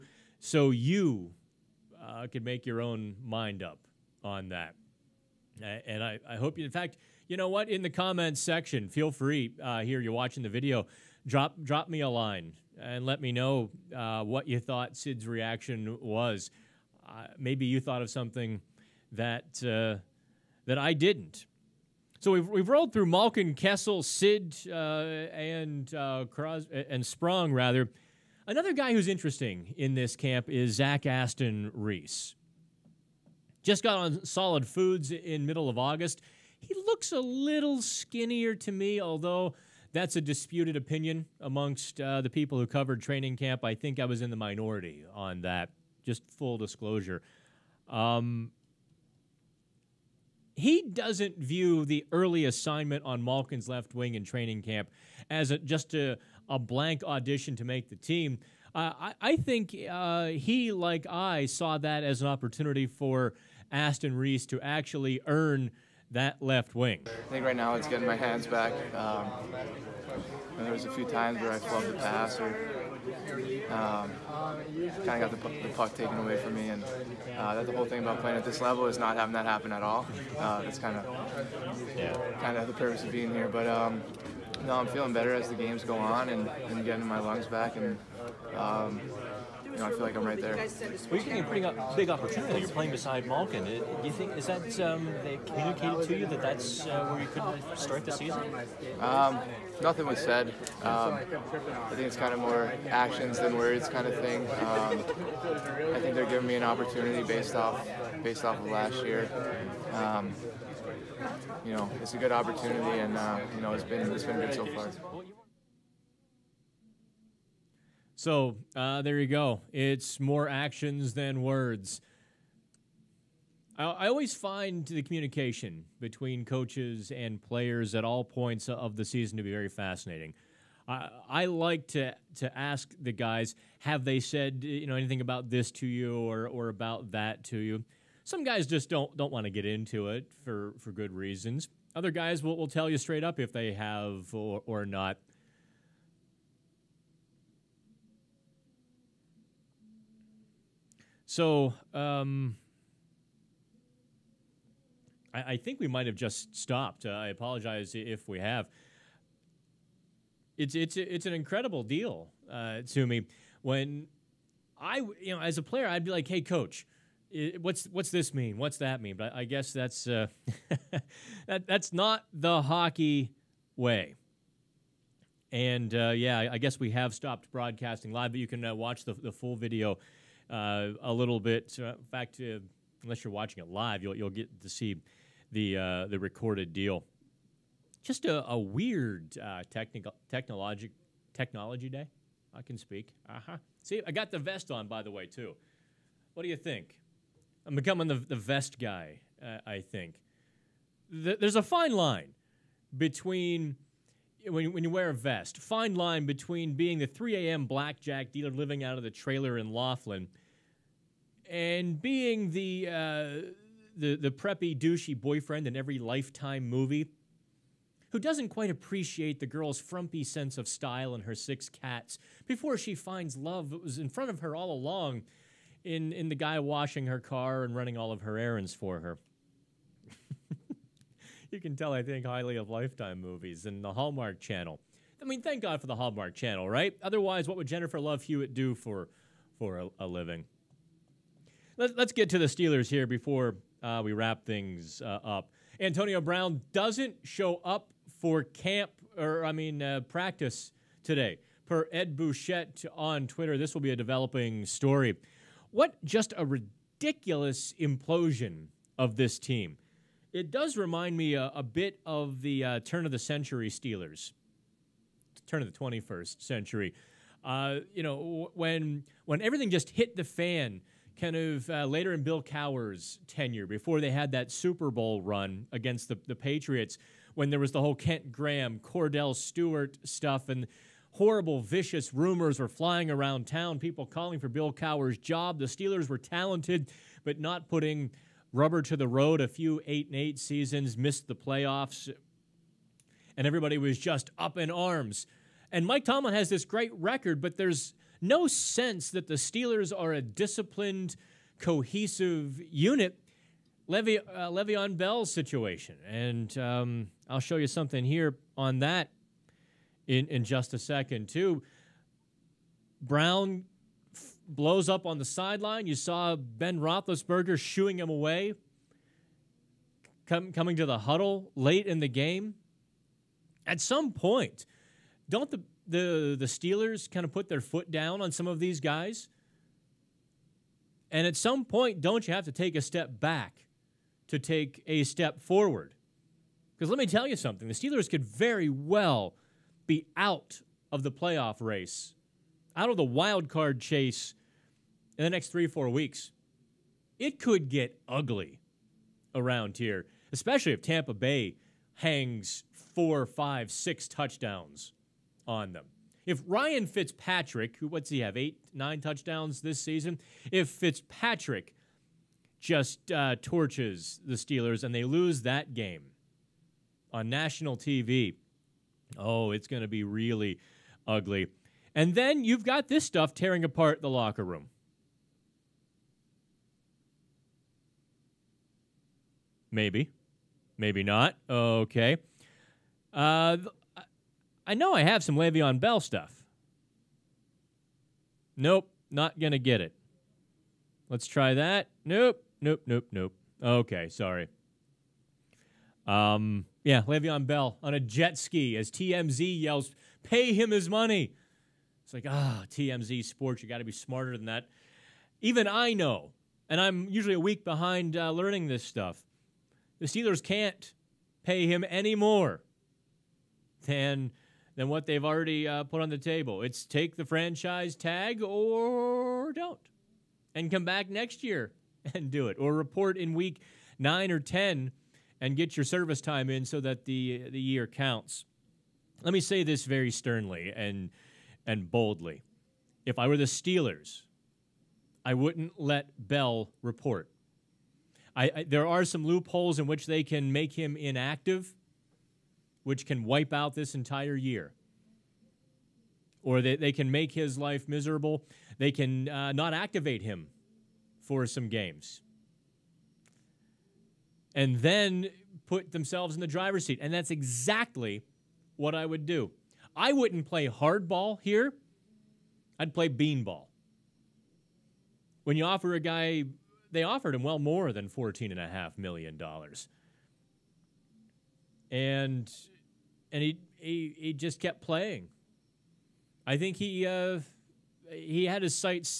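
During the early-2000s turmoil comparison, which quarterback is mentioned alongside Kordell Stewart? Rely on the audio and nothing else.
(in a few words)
Kent Graham.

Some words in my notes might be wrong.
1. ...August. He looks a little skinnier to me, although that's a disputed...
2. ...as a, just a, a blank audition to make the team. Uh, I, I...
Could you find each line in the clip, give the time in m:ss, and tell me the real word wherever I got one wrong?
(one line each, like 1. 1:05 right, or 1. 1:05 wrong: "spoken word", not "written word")
1. 0:35 right
2. 0:55 right.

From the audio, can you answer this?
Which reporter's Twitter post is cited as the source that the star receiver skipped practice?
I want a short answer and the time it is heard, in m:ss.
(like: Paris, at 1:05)
Ed Bouchette, at 4:11.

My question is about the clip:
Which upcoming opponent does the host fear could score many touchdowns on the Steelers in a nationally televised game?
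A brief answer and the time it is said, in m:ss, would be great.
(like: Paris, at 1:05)
Tampa Bay, at 5:50.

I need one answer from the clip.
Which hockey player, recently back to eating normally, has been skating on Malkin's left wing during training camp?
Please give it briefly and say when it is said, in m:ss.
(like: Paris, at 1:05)
Zach Aston Reese, at 0:30.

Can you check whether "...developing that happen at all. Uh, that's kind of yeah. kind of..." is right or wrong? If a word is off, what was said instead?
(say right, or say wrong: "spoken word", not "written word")
wrong: "having", not "developing".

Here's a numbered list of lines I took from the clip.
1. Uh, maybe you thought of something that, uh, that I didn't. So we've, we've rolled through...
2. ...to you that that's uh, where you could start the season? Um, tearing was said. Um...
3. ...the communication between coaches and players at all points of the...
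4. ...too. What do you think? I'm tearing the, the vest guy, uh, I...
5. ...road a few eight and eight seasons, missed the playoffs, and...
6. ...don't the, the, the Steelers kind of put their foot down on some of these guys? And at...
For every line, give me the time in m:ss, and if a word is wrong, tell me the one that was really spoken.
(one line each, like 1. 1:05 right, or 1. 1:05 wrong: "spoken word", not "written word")
1. 0:17 right
2. 1:36 wrong: "nothing", not "tearing"
3. 2:04 right
4. 3:15 wrong: "becoming", not "tearing"
5. 4:49 right
6. 5:25 right.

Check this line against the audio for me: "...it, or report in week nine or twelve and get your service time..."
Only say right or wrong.
wrong.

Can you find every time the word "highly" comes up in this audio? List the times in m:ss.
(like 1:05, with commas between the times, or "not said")
3:52.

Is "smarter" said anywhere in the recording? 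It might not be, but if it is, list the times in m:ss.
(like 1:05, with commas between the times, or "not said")
6:43.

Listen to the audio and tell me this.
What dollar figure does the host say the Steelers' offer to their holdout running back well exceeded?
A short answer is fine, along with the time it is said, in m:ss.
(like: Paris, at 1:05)
$14.5 million, at 7:48.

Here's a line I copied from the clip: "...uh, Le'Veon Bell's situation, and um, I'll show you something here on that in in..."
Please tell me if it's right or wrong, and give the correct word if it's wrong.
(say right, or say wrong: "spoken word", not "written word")
right.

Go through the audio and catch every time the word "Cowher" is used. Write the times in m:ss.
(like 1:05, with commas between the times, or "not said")
4:32, 4:44.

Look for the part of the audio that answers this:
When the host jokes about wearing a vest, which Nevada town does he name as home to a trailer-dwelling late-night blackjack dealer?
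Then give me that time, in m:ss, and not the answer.
3:29.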